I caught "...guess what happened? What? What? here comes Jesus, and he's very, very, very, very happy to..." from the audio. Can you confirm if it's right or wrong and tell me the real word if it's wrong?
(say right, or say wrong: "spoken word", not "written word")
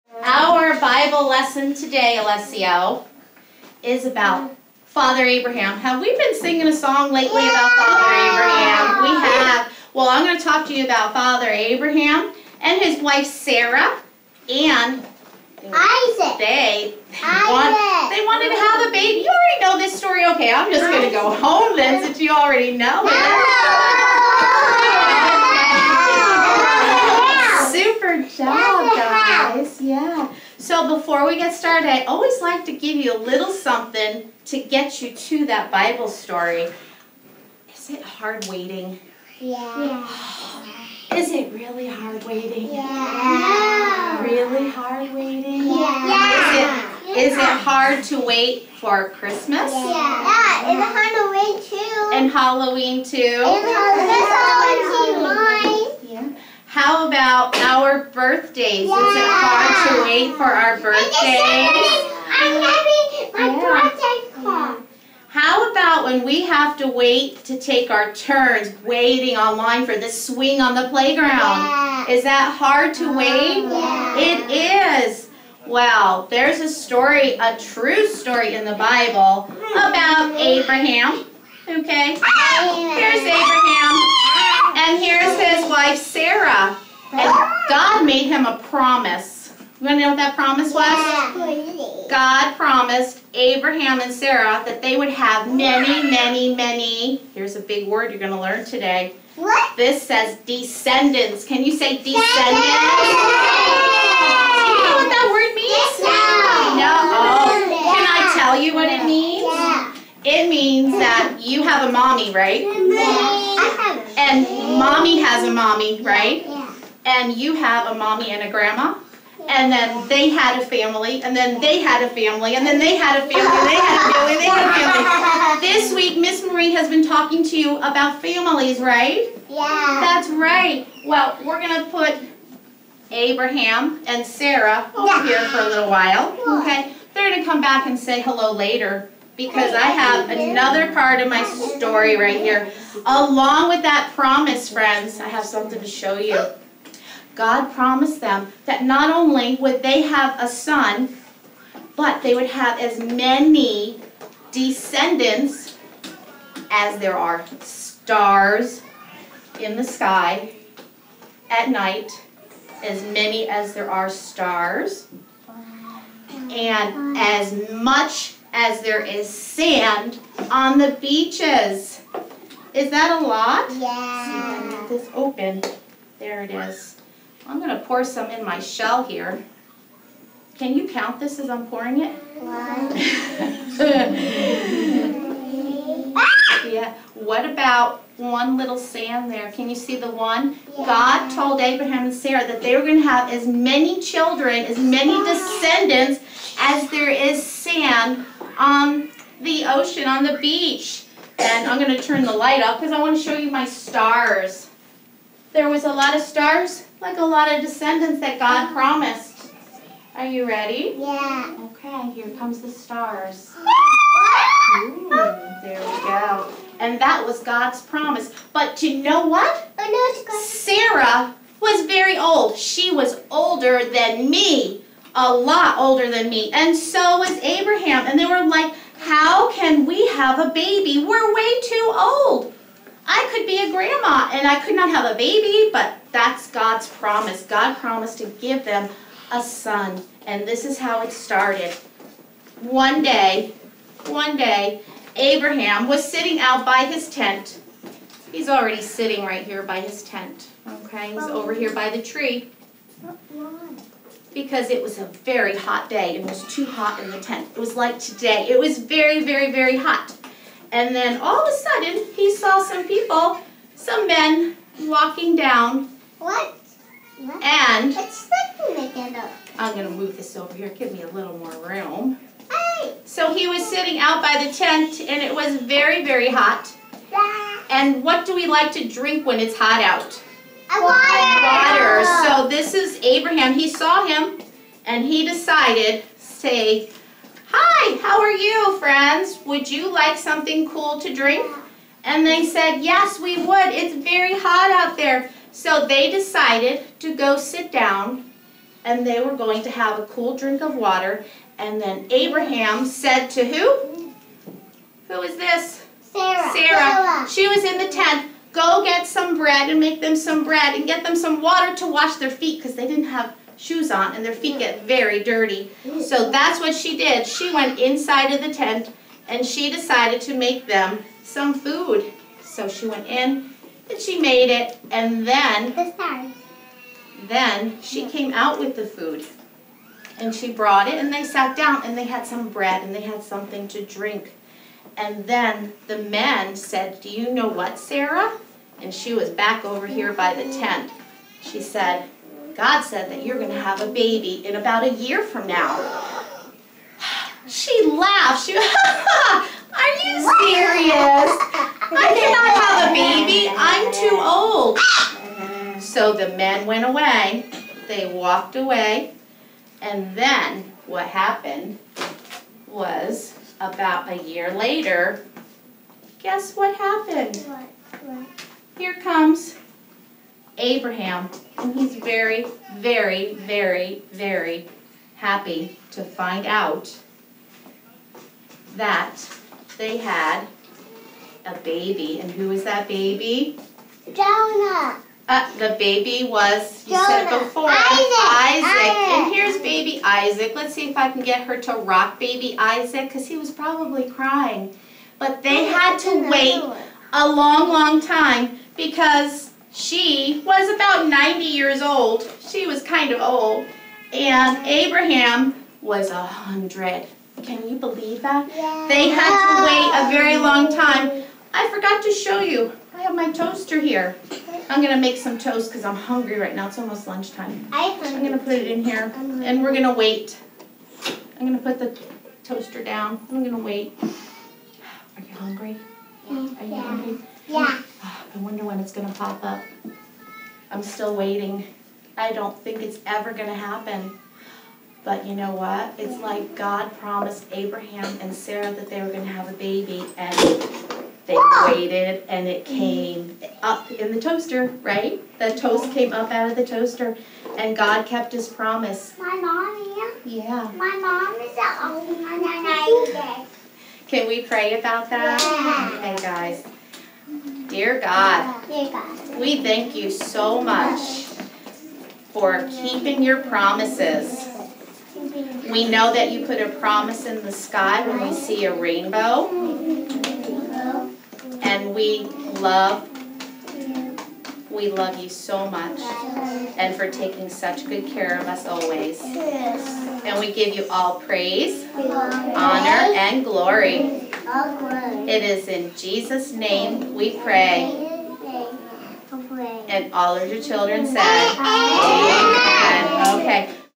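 wrong: "Abraham", not "Jesus".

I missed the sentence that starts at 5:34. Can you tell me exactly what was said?
And then the men said, "Do you know what, Sarah?" and she was back over here by the tent.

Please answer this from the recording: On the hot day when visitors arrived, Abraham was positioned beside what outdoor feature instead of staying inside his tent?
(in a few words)
the tree.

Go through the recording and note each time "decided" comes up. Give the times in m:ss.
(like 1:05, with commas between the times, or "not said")
4:45, 4:56, 5:19.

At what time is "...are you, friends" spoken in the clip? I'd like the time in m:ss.
4:48.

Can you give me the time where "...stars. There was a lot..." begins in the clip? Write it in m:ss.
3:23.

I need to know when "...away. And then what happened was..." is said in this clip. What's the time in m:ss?
5:58.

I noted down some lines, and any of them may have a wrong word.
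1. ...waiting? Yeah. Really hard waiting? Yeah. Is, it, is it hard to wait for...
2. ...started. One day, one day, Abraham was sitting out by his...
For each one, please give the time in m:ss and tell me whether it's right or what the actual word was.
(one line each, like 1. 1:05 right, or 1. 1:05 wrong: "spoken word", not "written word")
1. 0:42 right
2. 4:01 right.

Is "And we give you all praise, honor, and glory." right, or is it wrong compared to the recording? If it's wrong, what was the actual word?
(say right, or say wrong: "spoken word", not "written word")
right.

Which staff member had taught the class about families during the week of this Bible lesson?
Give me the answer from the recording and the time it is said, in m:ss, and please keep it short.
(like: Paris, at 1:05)
Miss Marie, at 2:06.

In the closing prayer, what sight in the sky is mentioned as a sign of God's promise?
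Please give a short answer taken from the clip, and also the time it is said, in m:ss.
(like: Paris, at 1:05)
rainbow, at 7:48.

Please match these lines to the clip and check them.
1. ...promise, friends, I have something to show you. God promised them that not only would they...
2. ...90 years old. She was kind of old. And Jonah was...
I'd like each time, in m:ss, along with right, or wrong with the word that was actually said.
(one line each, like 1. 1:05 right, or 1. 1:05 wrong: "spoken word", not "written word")
1. 2:24 right
2. 6:41 wrong: "Abraham", not "Jonah".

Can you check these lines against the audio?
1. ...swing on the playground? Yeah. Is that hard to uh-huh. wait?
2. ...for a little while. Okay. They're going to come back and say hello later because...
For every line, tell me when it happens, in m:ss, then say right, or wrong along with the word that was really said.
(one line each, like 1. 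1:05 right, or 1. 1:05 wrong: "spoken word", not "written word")
1. 1:10 right
2. 2:15 right.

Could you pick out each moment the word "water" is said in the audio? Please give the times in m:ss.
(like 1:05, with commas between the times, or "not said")
4:40, 5:00, 5:11.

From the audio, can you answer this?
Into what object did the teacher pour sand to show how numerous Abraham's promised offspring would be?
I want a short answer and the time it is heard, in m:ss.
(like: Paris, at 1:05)
shell, at 2:58.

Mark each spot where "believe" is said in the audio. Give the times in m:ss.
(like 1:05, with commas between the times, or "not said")
6:47.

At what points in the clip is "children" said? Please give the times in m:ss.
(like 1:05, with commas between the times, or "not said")
3:14, 8:10.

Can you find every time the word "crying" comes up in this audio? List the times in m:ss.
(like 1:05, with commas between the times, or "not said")
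6:34.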